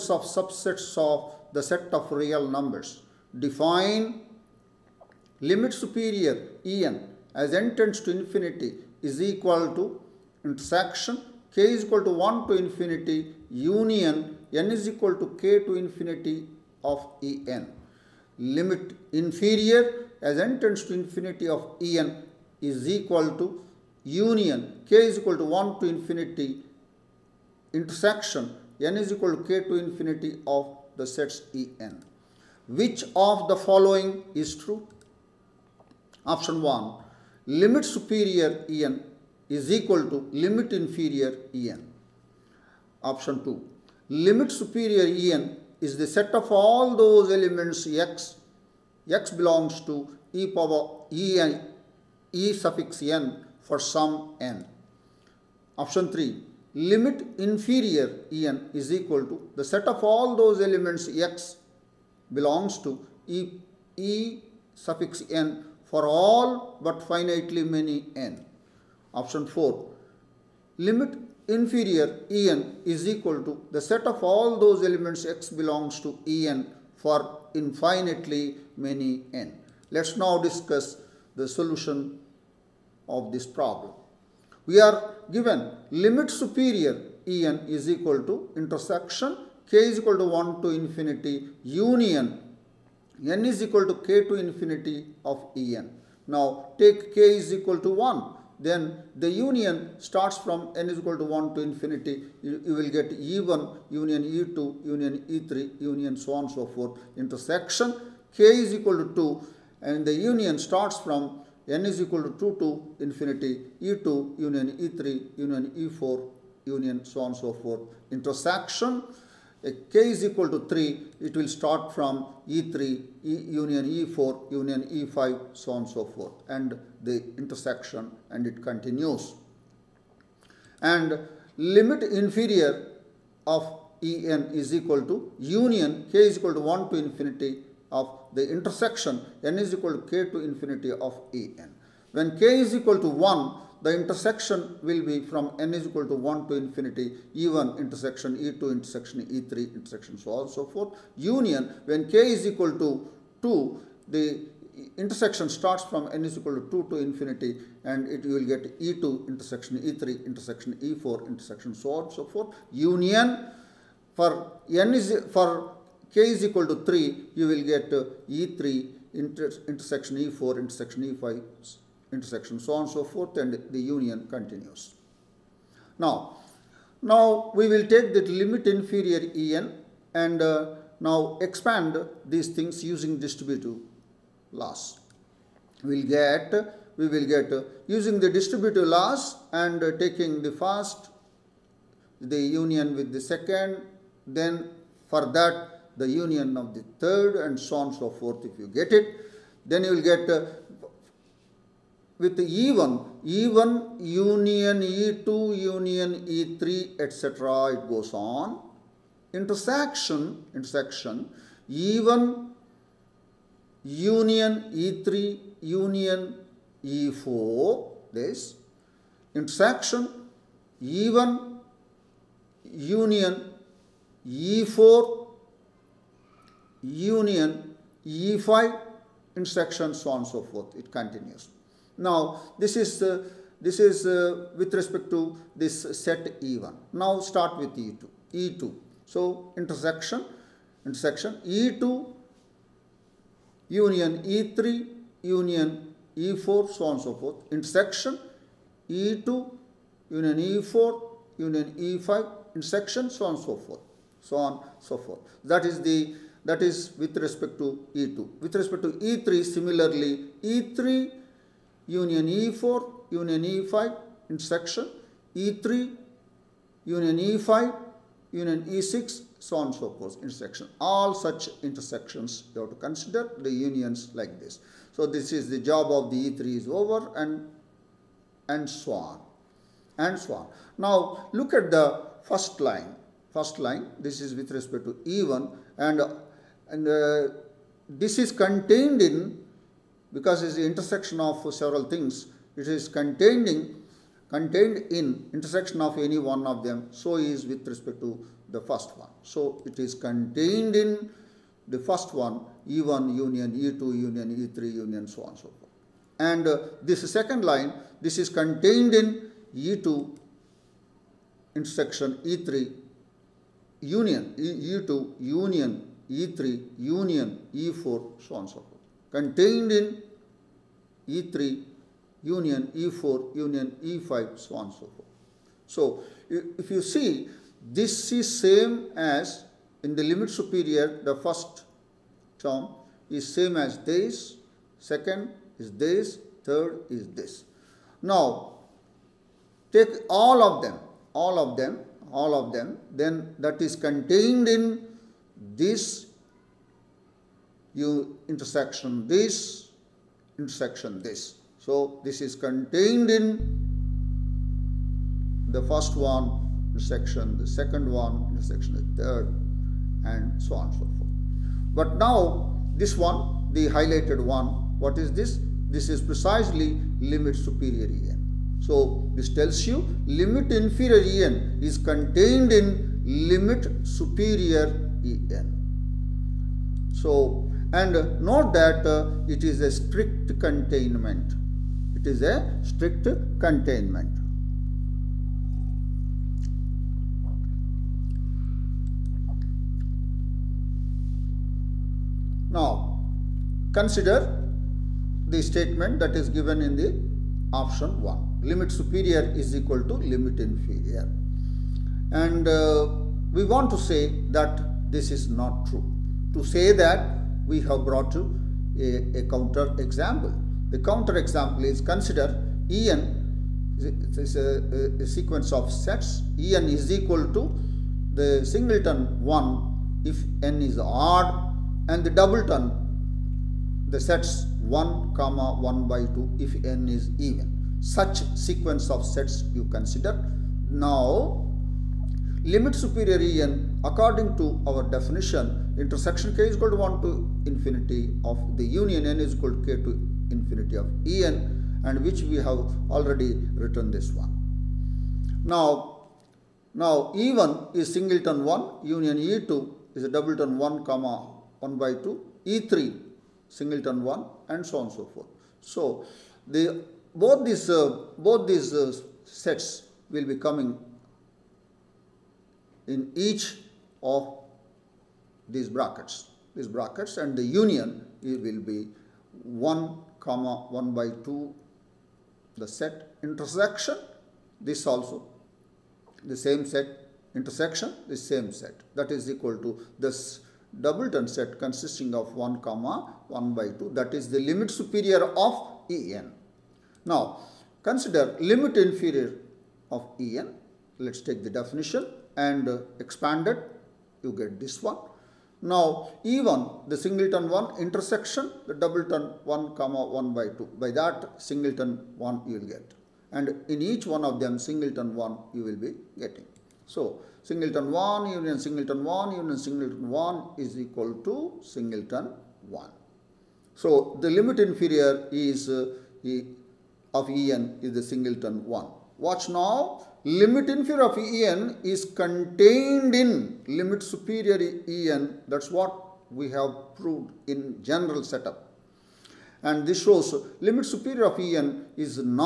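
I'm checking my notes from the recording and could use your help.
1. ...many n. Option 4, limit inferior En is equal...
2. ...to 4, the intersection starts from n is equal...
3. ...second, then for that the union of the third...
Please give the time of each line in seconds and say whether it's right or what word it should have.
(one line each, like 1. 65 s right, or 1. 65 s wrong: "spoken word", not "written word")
1. 67 s right
2. 152 s wrong: "2", not "4"
3. 193 s right.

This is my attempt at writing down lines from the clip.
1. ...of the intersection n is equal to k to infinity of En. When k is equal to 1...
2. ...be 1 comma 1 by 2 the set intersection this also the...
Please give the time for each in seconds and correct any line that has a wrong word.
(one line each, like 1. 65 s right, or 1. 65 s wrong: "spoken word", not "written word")
1. 137 s right
2. 468 s right.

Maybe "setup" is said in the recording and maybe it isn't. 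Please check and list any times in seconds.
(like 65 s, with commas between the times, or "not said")
528 s.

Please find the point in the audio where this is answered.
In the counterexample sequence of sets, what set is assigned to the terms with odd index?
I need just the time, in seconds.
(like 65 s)
418 s.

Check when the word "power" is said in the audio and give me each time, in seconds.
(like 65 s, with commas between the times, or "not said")
50 s.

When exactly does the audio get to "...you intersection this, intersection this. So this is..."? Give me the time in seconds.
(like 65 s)
347 s.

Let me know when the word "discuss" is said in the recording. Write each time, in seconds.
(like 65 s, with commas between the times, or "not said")
80 s.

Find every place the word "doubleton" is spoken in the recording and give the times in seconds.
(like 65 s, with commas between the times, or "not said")
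422 s, 450 s, 480 s, 498 s.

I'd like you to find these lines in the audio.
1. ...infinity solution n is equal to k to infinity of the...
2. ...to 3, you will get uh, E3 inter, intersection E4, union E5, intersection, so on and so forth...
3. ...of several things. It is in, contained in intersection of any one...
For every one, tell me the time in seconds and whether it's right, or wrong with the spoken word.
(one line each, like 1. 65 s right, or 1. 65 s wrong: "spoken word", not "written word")
1. 25 s wrong: "intersection", not "solution"
2. 166 s wrong: "intersection", not "union"
3. 291 s right.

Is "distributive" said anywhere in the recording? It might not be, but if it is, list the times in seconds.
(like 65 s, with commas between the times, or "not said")
183 s, 188 s.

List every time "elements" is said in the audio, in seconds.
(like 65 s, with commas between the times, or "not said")
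47 s, 60 s, 74 s.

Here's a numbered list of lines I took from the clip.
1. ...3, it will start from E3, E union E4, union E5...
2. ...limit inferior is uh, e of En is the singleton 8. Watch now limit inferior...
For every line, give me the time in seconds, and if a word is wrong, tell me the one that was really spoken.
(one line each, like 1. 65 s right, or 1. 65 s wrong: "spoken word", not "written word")
1. 120 s right
2. 514 s wrong: "1", not "8".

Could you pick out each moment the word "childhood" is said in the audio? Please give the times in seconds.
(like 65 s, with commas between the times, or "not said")
not said.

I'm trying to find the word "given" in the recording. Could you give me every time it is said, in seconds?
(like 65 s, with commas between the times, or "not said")
85 s, 396 s.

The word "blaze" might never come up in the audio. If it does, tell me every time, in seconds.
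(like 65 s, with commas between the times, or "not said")
not said.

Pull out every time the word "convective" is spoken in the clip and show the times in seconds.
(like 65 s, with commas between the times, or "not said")
not said.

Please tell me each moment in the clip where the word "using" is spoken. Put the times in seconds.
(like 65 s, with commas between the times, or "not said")
182 s, 187 s.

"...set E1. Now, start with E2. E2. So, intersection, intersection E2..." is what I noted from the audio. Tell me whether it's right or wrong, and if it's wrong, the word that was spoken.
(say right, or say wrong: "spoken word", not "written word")
right.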